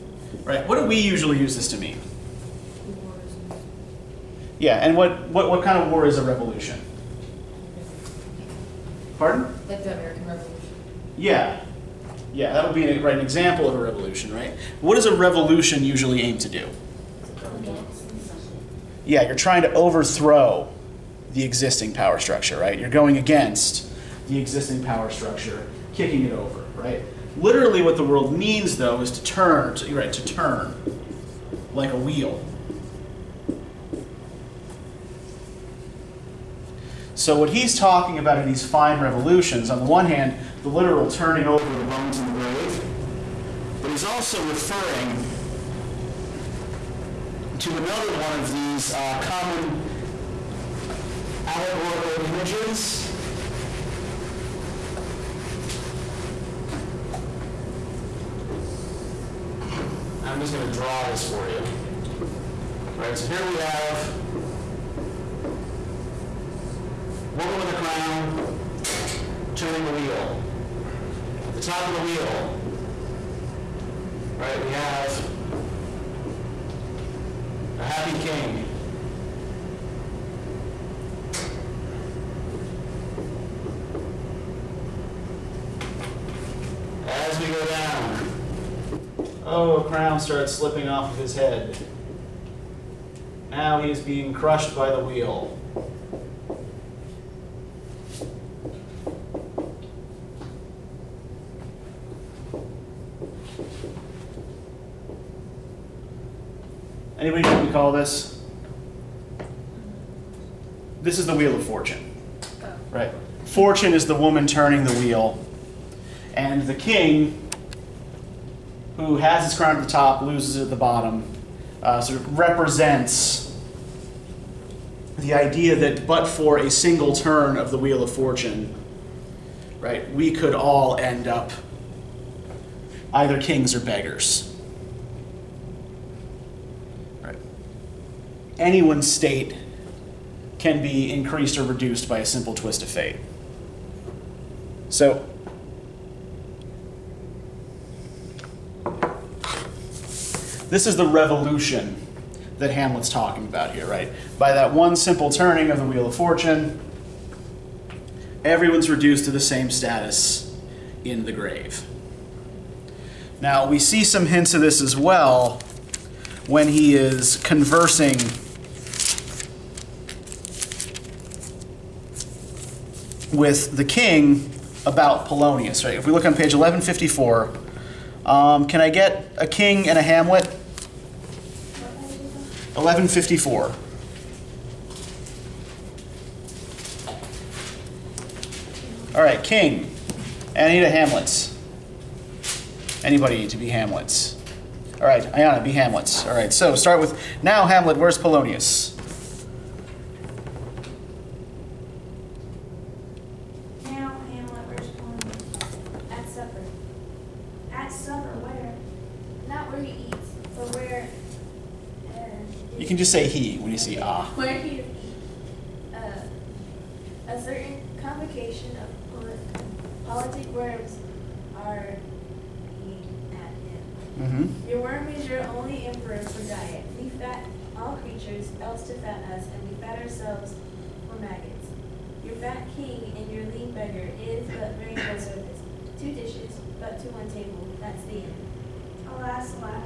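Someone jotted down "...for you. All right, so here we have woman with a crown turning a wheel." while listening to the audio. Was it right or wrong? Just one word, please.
right.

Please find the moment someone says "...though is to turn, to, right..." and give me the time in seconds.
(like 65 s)
28 s.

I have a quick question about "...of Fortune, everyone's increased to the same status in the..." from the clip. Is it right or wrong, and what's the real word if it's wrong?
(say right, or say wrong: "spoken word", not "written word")
wrong: "reduced", not "increased".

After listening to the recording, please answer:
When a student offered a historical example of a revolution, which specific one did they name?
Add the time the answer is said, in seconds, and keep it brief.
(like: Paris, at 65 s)
American Revolution, at 9 s.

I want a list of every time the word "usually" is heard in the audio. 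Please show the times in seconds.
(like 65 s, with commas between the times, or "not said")
0 s, 15 s.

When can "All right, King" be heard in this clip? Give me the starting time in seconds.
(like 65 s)
189 s.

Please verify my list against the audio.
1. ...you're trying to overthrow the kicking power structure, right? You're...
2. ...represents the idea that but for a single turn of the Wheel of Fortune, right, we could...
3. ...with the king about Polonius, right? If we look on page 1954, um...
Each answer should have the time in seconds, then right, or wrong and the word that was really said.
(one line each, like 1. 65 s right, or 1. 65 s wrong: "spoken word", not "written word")
1. 19 s wrong: "existing", not "kicking"
2. 122 s right
3. 173 s wrong: "1154", not "1954".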